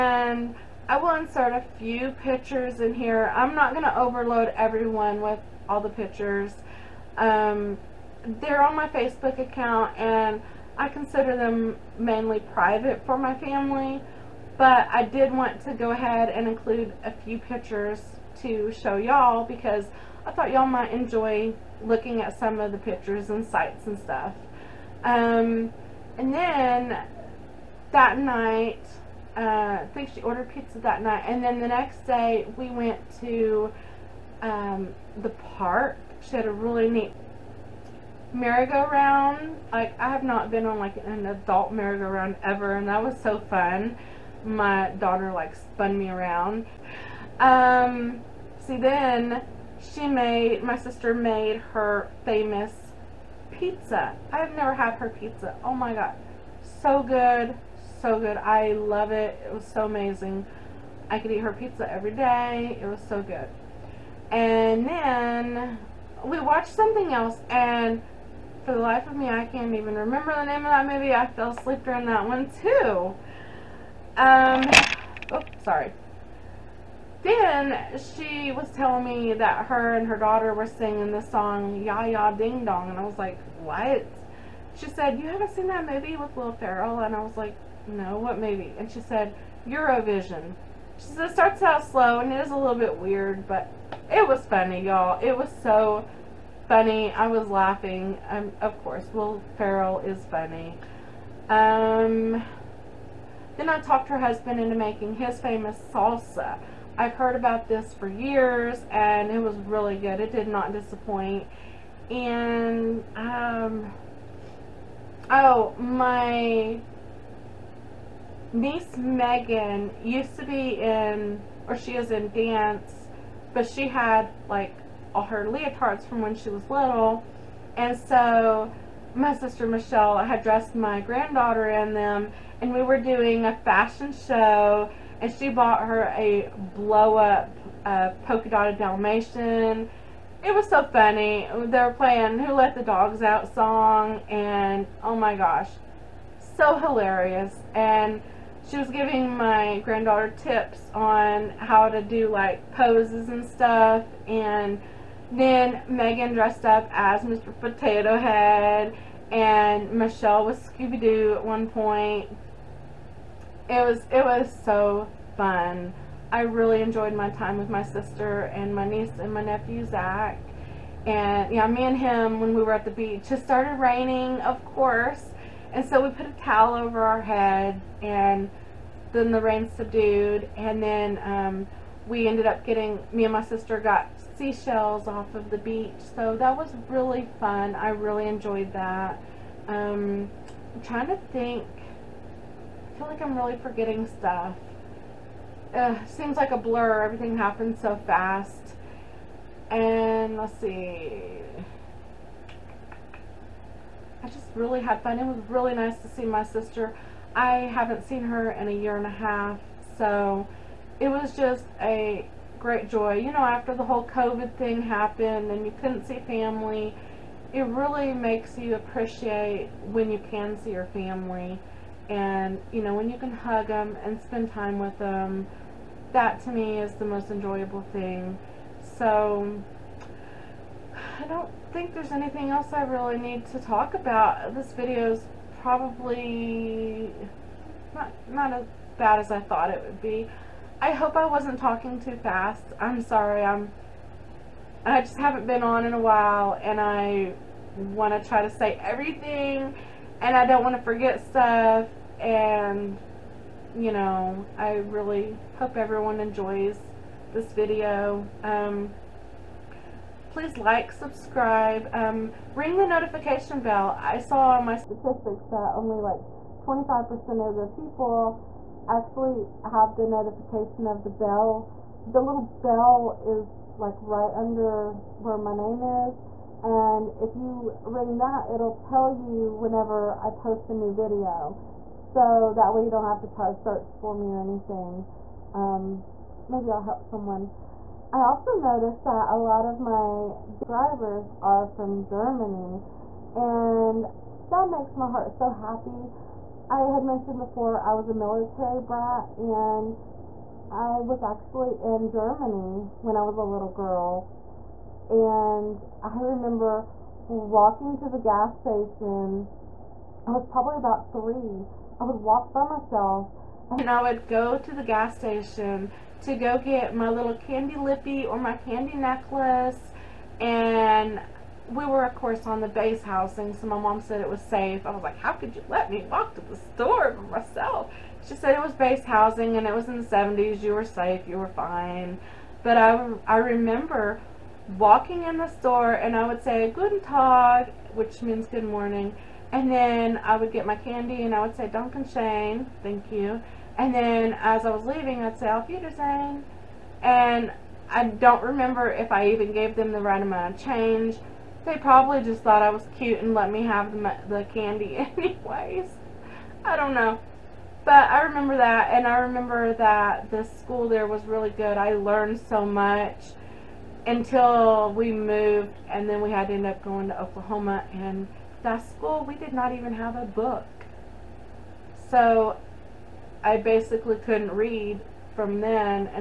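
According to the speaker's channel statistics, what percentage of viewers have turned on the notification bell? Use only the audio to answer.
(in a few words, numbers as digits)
25%.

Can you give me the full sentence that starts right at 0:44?
My daughter, like, spun me around.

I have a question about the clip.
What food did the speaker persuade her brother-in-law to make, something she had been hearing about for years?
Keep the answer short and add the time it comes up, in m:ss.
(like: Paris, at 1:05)
Salsa, at 1:45.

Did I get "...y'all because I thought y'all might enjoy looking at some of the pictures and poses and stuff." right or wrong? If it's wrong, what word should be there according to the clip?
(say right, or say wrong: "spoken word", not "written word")
wrong: "sites", not "poses".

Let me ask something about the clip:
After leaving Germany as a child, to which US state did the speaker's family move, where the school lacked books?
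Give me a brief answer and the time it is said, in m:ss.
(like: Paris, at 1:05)
Oklahoma, at 6:07.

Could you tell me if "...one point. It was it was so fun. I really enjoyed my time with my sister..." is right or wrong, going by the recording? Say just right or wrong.
right.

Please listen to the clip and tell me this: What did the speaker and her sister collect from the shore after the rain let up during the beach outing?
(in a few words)
Seashells.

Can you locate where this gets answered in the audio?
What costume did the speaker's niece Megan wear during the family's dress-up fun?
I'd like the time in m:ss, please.
2:37.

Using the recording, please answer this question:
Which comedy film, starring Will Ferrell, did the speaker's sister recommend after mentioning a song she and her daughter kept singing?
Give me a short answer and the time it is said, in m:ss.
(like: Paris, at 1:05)
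Eurovision, at 1:29.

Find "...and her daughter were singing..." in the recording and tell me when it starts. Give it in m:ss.
1:19.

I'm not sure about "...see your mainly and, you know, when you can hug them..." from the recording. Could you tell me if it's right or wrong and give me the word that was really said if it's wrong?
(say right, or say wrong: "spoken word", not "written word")
wrong: "family", not "mainly".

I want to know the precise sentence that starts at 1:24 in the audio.
She said, you haven't seen that movie with Will Ferrell?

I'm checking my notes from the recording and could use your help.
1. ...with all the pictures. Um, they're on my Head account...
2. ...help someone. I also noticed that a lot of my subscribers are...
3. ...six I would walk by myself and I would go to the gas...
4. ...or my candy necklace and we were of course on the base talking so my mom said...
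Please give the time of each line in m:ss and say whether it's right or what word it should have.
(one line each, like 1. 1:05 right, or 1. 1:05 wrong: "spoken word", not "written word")
1. 0:05 wrong: "Facebook", not "Head"
2. 4:46 right
3. 5:11 wrong: "three", not "six"
4. 5:18 wrong: "housing", not "talking".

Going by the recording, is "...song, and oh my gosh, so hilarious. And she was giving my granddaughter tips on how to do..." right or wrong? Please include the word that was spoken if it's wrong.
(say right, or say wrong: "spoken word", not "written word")
right.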